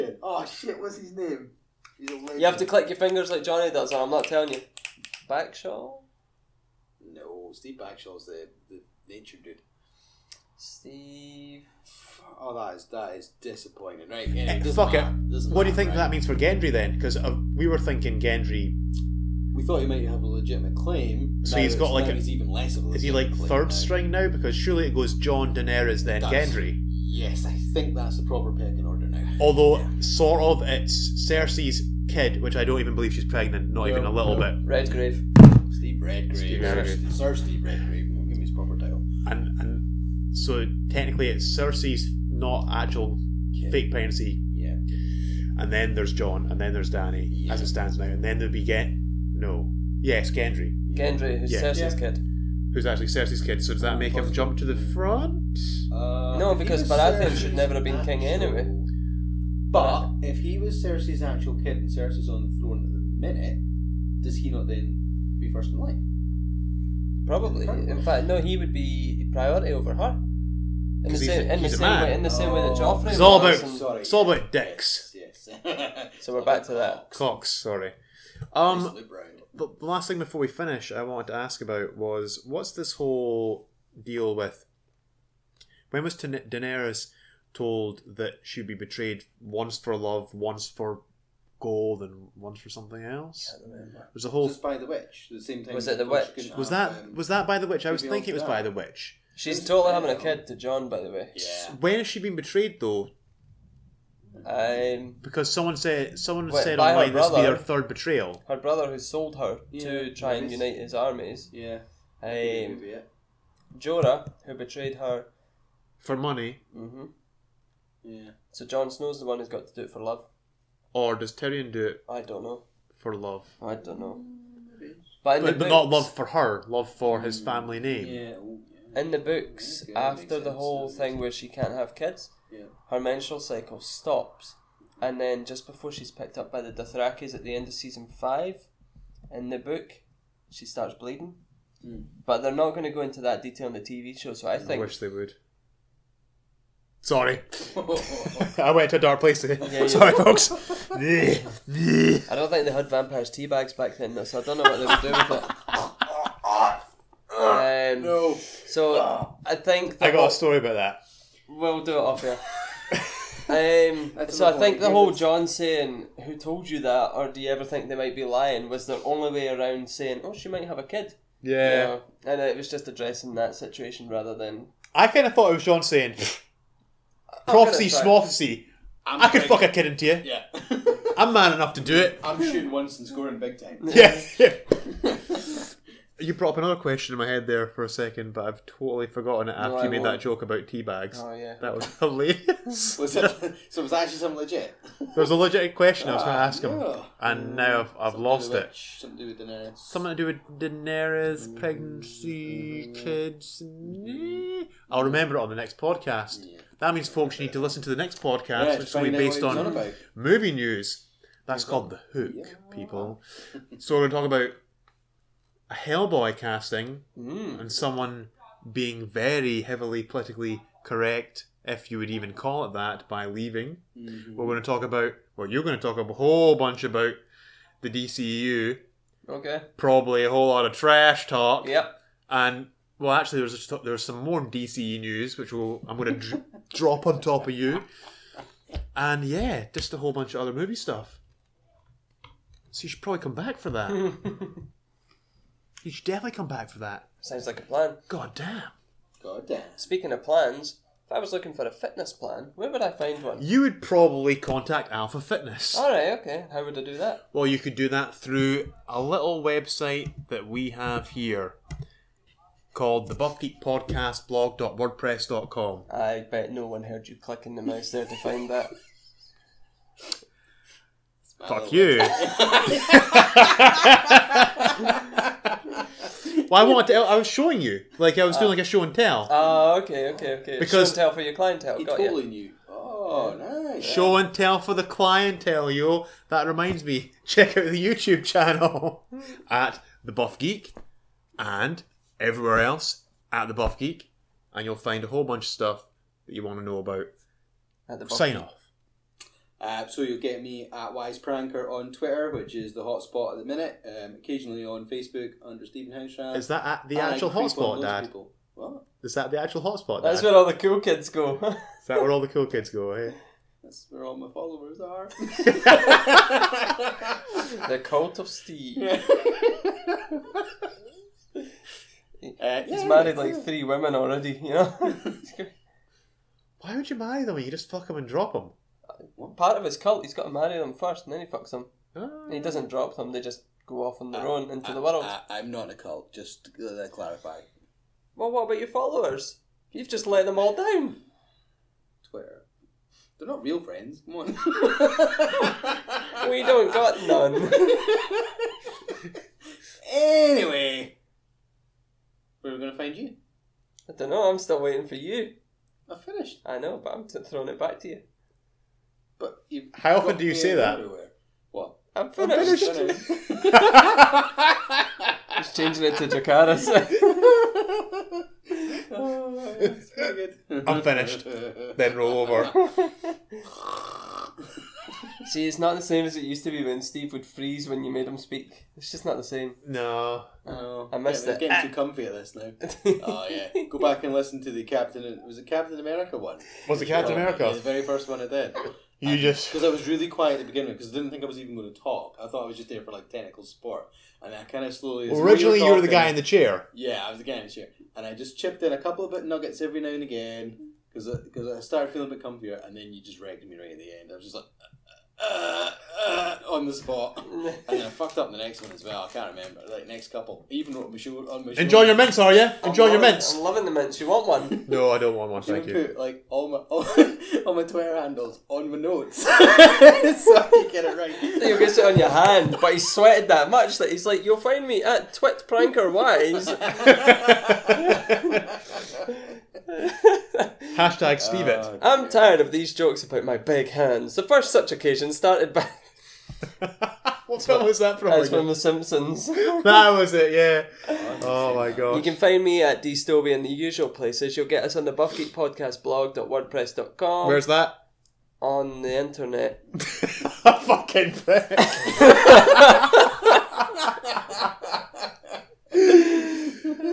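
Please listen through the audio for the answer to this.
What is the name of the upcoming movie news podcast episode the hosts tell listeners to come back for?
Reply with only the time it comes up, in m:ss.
3:31.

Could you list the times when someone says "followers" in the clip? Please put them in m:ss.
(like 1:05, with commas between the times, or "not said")
5:14, 5:38.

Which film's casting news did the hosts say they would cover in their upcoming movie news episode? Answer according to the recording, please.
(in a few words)
Hellboy.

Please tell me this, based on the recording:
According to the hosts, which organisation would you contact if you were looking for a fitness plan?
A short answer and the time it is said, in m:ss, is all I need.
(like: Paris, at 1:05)
Alpha Fitness, at 4:14.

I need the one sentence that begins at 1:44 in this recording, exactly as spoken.
Um, because someone said someone wait, said online brother, this would be her third betrayal.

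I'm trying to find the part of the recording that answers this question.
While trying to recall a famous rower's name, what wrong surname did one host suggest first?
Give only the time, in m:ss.
0:07.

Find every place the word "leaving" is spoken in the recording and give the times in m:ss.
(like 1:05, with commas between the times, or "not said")
3:43.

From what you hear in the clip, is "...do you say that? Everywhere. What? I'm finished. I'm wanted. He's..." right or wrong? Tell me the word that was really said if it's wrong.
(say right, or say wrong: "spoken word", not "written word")
wrong: "finished", not "wanted".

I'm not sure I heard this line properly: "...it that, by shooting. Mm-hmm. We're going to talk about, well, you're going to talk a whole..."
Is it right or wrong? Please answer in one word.
wrong.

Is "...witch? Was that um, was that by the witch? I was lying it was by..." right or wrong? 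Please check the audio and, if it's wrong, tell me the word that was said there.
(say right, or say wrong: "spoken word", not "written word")
wrong: "thinking", not "lying".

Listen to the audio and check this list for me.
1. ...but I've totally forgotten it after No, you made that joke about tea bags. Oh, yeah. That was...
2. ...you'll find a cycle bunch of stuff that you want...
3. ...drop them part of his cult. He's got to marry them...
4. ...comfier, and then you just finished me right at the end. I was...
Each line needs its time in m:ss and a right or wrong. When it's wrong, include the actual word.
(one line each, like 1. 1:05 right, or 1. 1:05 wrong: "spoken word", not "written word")
1. 3:08 right
2. 4:54 wrong: "whole", not "cycle"
3. 5:28 right
4. 6:42 wrong: "ragged", not "finished".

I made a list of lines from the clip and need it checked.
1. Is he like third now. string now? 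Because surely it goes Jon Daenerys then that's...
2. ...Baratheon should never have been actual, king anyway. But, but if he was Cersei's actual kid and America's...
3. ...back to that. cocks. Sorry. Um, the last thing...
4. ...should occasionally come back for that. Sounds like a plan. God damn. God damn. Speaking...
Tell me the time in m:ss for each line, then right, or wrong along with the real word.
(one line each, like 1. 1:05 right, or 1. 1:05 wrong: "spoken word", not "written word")
1. 0:22 right
2. 0:56 wrong: "Cersei", not "America"
3. 1:16 right
4. 4:05 wrong: "definitely", not "occasionally".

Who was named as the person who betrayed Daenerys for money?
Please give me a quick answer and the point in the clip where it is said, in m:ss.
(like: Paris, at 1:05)
Jorah, at 1:53.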